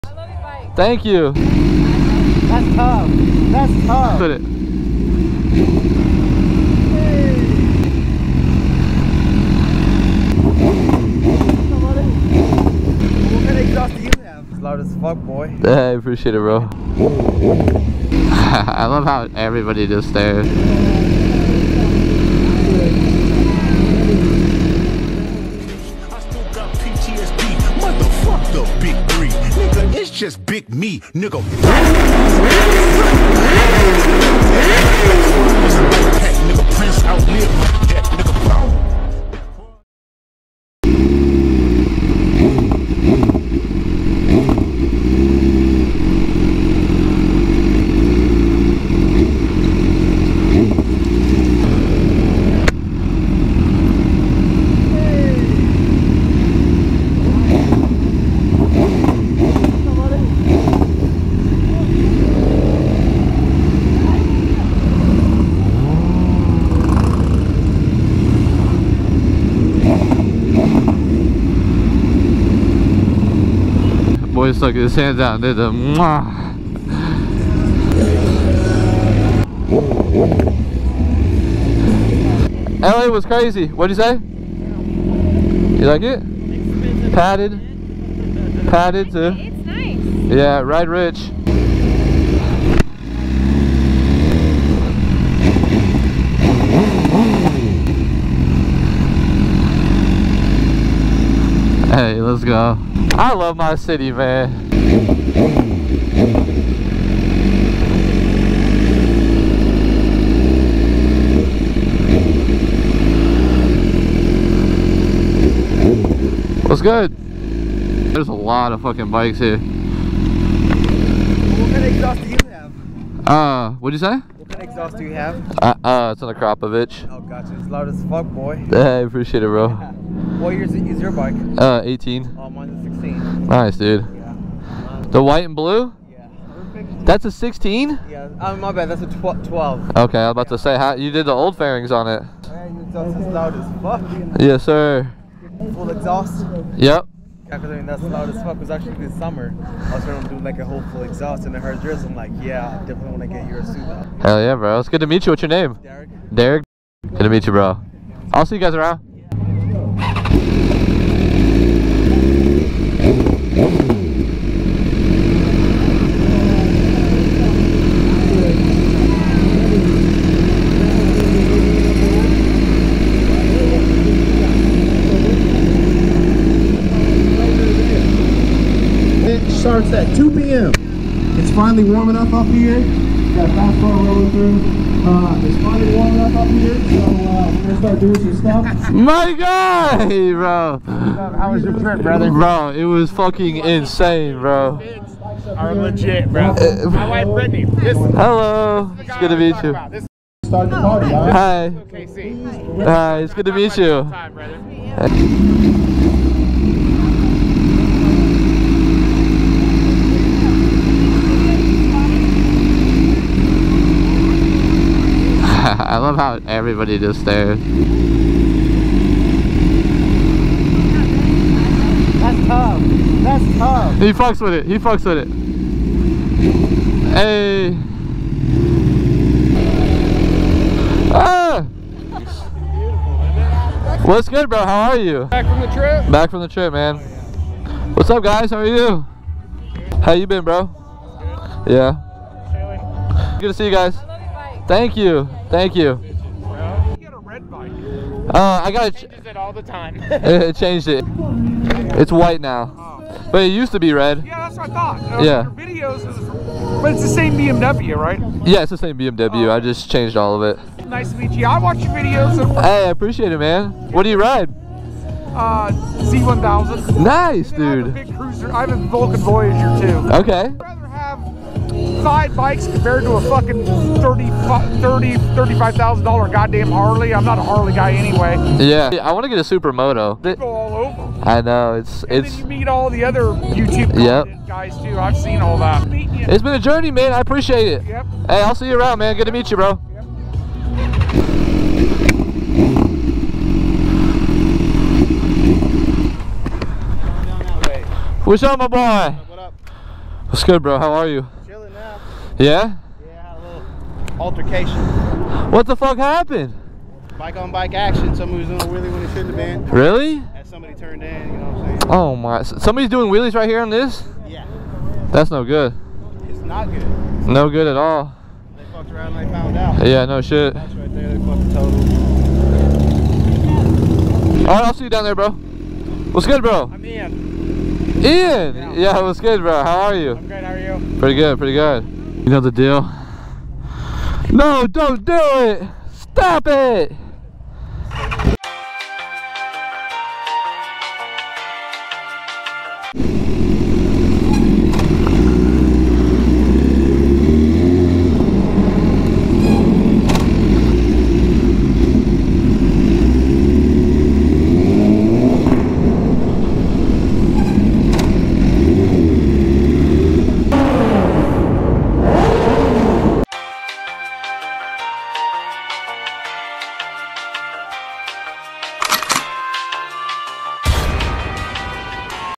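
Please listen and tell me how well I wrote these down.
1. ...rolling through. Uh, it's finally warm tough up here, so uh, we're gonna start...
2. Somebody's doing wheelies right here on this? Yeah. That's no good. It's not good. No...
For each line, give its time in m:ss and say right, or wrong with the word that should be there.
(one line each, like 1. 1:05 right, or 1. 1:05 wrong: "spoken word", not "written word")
1. 3:03 wrong: "enough", not "tough"
2. 5:12 right.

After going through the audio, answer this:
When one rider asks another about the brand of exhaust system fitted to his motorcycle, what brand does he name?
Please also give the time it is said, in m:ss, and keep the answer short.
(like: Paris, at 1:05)
Kropovich, at 2:06.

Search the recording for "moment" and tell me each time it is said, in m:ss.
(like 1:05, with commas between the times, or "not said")
not said.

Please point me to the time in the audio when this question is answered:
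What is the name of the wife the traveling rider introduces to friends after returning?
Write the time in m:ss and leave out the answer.
3:17.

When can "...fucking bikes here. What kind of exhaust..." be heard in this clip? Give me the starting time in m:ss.
1:58.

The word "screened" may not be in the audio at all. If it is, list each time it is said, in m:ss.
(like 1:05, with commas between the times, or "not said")
not said.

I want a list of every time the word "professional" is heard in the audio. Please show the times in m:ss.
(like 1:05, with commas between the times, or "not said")
not said.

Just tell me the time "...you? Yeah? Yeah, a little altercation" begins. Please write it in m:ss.
5:01.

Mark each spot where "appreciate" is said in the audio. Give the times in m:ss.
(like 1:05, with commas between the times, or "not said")
0:15, 2:09, 4:22, 4:47.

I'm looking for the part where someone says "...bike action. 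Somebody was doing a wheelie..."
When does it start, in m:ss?
5:07.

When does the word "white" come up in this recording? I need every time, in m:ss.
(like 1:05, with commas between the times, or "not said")
2:15, 4:12.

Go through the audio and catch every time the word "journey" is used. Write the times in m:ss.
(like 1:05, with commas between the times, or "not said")
4:46.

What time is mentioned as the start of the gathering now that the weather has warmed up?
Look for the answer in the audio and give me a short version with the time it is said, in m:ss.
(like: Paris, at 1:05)
2 p.m., at 3:00.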